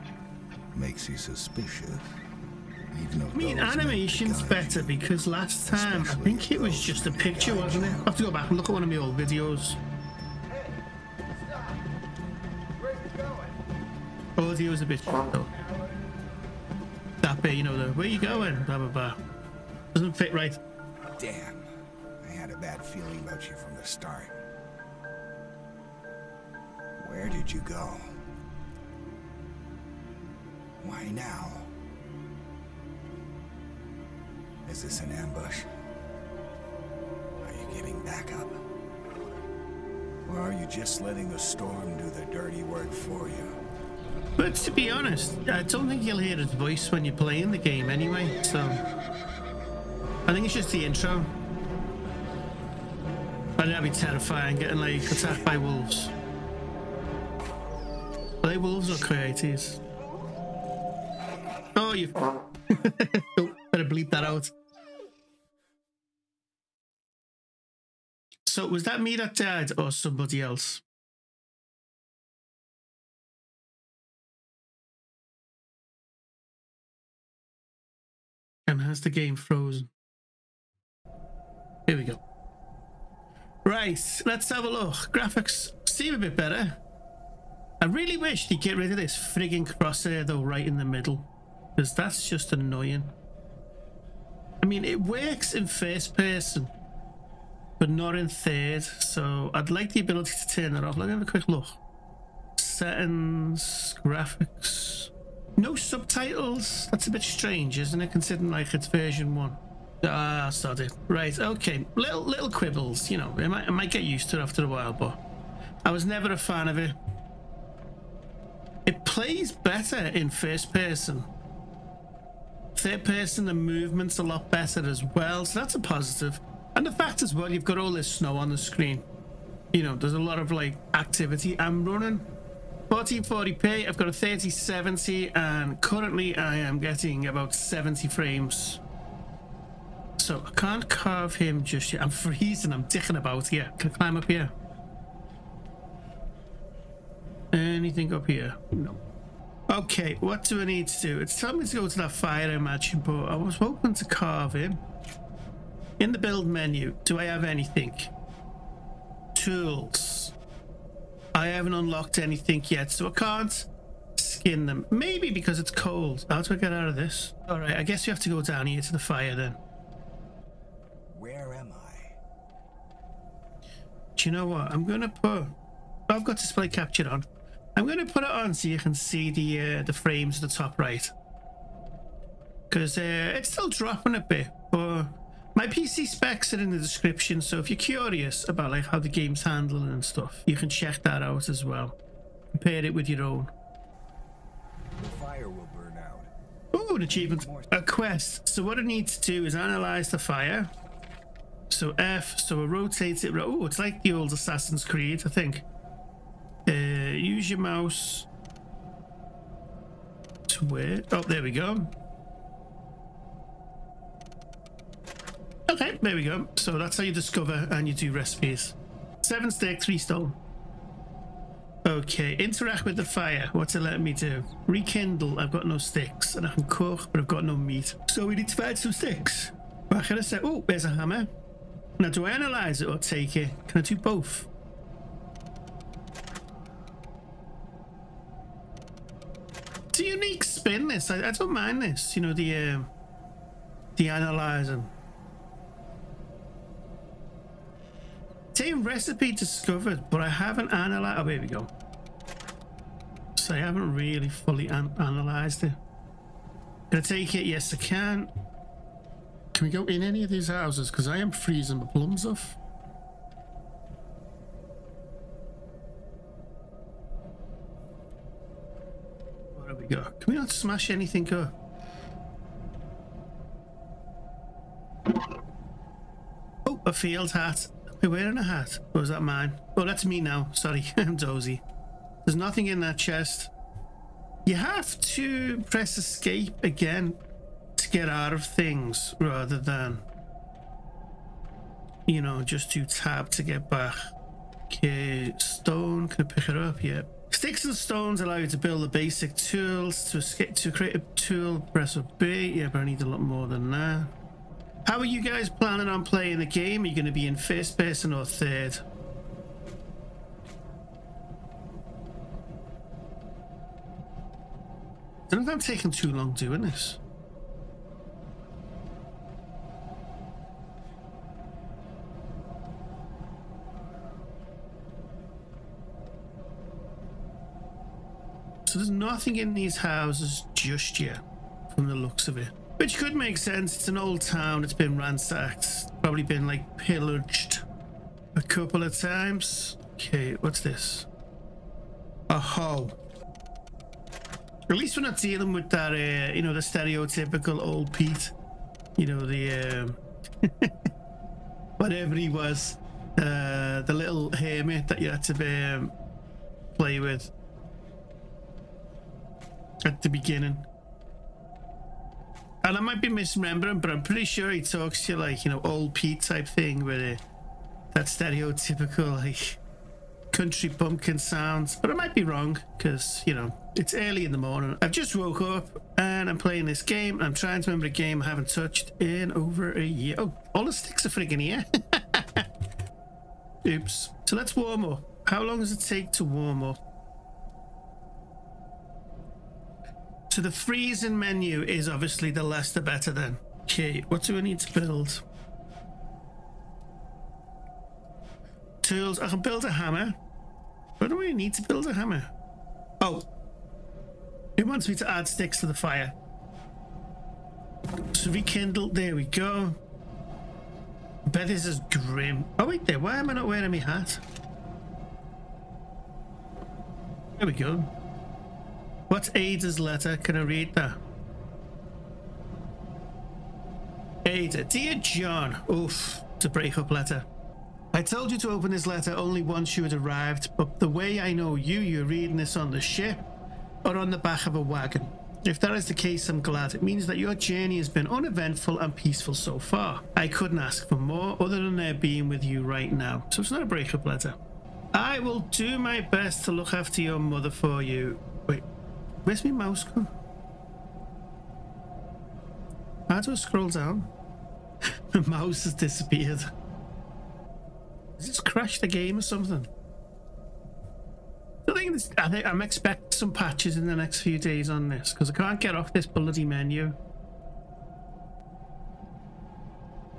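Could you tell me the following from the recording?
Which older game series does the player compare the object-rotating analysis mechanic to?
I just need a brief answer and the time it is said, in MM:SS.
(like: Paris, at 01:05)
Assassin's Creed, at 03:24.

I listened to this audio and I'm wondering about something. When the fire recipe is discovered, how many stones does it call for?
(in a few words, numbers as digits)
3.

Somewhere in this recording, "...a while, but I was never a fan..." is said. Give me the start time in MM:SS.
01:54.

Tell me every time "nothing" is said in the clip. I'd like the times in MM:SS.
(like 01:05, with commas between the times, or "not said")
04:42, 05:28.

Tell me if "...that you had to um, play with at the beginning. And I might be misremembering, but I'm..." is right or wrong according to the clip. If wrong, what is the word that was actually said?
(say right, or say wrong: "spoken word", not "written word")
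right.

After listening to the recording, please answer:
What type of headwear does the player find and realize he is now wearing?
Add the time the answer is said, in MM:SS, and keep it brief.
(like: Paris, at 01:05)
field hat, at 04:36.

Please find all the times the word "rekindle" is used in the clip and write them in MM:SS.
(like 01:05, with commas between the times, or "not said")
03:44, 06:48.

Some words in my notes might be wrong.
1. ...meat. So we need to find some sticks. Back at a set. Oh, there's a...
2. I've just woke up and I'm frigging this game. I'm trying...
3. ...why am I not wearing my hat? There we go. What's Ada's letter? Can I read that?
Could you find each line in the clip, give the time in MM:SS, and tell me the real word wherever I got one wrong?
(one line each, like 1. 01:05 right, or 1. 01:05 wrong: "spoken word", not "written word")
1. 03:47 right
2. 06:14 wrong: "playing", not "frigging"
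3. 06:52 right.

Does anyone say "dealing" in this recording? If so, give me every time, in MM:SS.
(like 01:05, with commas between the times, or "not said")
05:45.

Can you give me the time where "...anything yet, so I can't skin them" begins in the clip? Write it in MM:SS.
02:42.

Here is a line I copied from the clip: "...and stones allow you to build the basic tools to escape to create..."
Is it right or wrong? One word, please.
right.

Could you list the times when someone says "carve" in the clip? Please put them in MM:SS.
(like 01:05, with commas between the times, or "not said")
02:20, 02:34.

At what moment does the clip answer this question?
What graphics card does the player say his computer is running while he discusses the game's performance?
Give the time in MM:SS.
02:14.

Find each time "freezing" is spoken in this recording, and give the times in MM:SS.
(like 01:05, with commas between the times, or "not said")
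02:22, 04:21, 06:30.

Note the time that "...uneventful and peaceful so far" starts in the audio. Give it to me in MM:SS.
07:18.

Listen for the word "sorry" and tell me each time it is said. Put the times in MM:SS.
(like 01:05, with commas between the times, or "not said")
01:50, 04:40.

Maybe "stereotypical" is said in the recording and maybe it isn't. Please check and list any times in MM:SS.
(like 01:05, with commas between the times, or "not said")
05:46, 06:08.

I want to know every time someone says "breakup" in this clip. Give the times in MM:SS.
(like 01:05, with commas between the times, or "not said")
07:06, 07:23.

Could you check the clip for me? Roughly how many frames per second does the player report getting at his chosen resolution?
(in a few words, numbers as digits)
70.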